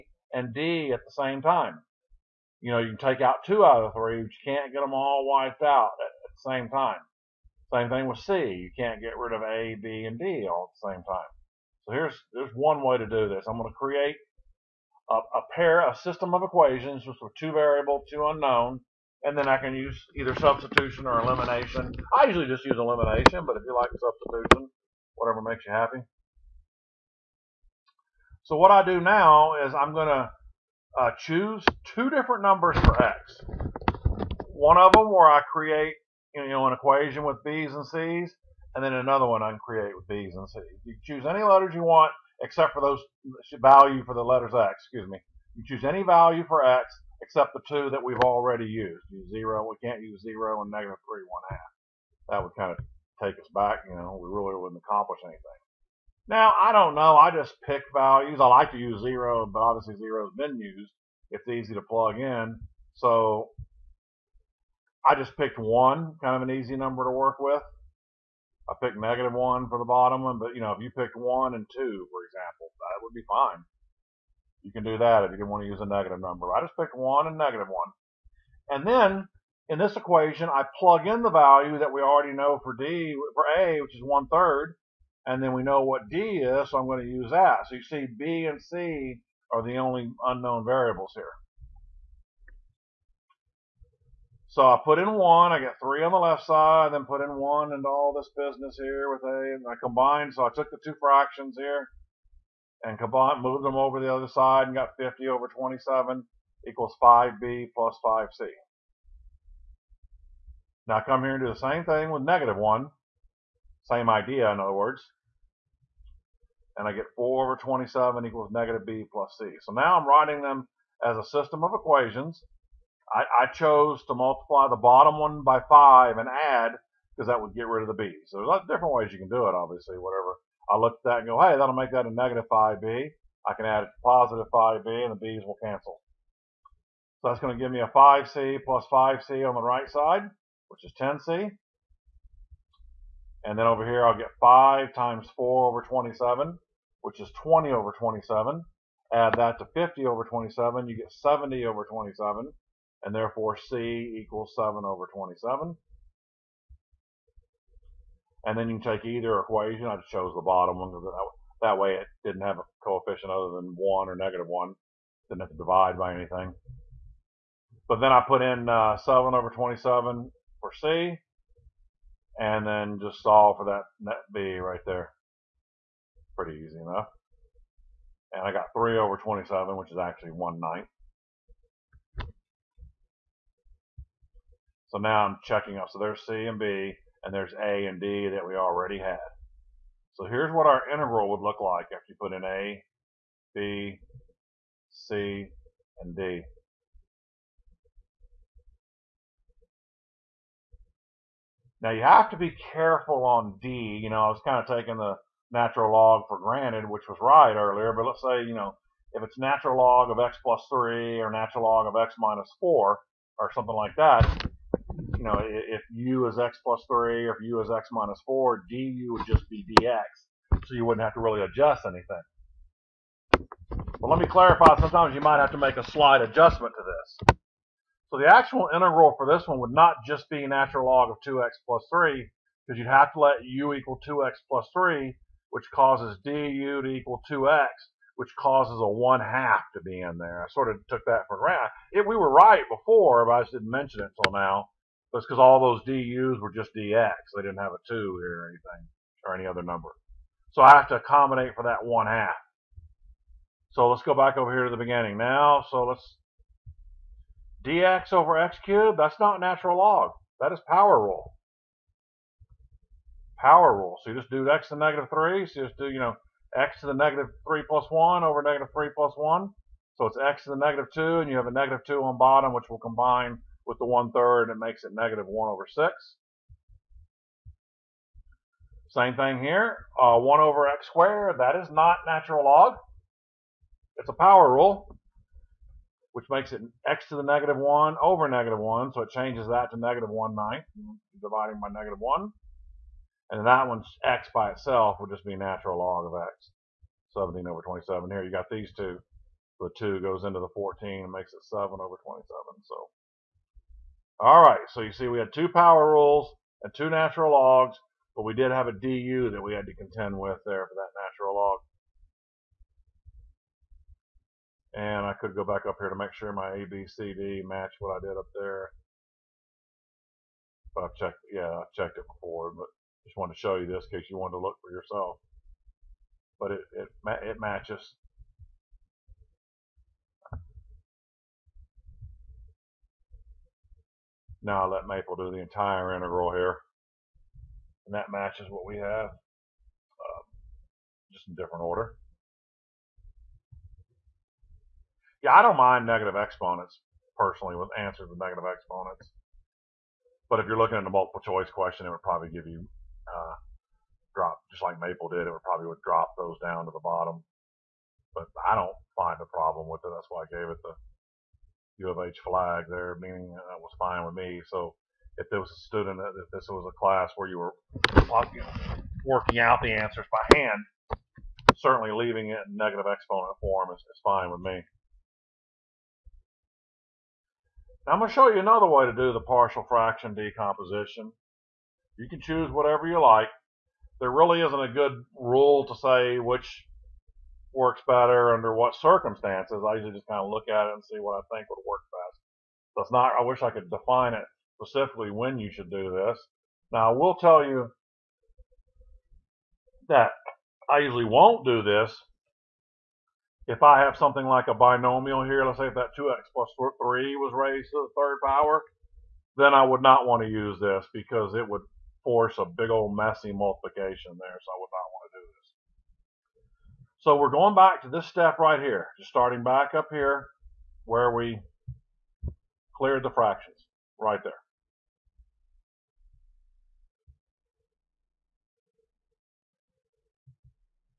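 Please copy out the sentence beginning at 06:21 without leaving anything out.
You can choose whatever you like.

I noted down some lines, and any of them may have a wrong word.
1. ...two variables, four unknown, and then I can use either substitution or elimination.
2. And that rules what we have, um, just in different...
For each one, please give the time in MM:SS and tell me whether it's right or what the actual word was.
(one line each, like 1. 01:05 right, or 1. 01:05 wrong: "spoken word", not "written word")
1. 00:17 wrong: "two", not "four"
2. 05:37 wrong: "matches", not "rules".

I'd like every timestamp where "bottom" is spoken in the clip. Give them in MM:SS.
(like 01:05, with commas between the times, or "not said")
01:09, 02:04, 02:40, 04:32, 05:56.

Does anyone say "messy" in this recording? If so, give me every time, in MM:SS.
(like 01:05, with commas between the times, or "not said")
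06:52.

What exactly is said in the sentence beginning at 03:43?
But let me clarify, sometimes you might have to make a slight adjustment to this.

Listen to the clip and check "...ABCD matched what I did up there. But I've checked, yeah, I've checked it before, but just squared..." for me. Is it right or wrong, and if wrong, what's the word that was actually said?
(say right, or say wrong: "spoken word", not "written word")
wrong: "wanted", not "squared".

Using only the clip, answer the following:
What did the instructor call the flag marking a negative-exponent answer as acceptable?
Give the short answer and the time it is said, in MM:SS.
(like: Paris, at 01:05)
U of H flag, at 06:01.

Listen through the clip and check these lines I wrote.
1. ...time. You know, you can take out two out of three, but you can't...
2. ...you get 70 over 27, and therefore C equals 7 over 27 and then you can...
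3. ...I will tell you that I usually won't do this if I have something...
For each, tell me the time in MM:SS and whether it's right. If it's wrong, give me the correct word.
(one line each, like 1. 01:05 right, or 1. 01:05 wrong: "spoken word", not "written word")
1. 00:01 right
2. 02:30 right
3. 06:36 right.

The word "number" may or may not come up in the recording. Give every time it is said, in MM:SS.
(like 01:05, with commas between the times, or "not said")
00:32, 01:06, 01:16, 04:09.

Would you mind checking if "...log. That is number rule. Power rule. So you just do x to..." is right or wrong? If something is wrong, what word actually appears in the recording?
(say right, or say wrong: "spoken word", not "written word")
wrong: "power", not "number".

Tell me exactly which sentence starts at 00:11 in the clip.
So here's, here's one way to do this.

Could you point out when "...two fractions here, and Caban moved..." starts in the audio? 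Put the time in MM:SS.
01:40.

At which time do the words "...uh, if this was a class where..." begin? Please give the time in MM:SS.
06:05.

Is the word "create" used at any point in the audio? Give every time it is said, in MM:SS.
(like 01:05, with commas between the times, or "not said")
00:13, 00:35, 00:39.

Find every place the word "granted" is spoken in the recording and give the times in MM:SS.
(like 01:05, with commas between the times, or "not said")
03:26, 04:01.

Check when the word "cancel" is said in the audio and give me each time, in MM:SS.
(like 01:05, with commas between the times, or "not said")
02:15.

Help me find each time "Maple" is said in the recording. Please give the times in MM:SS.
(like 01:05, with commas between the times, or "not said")
05:34, 05:54.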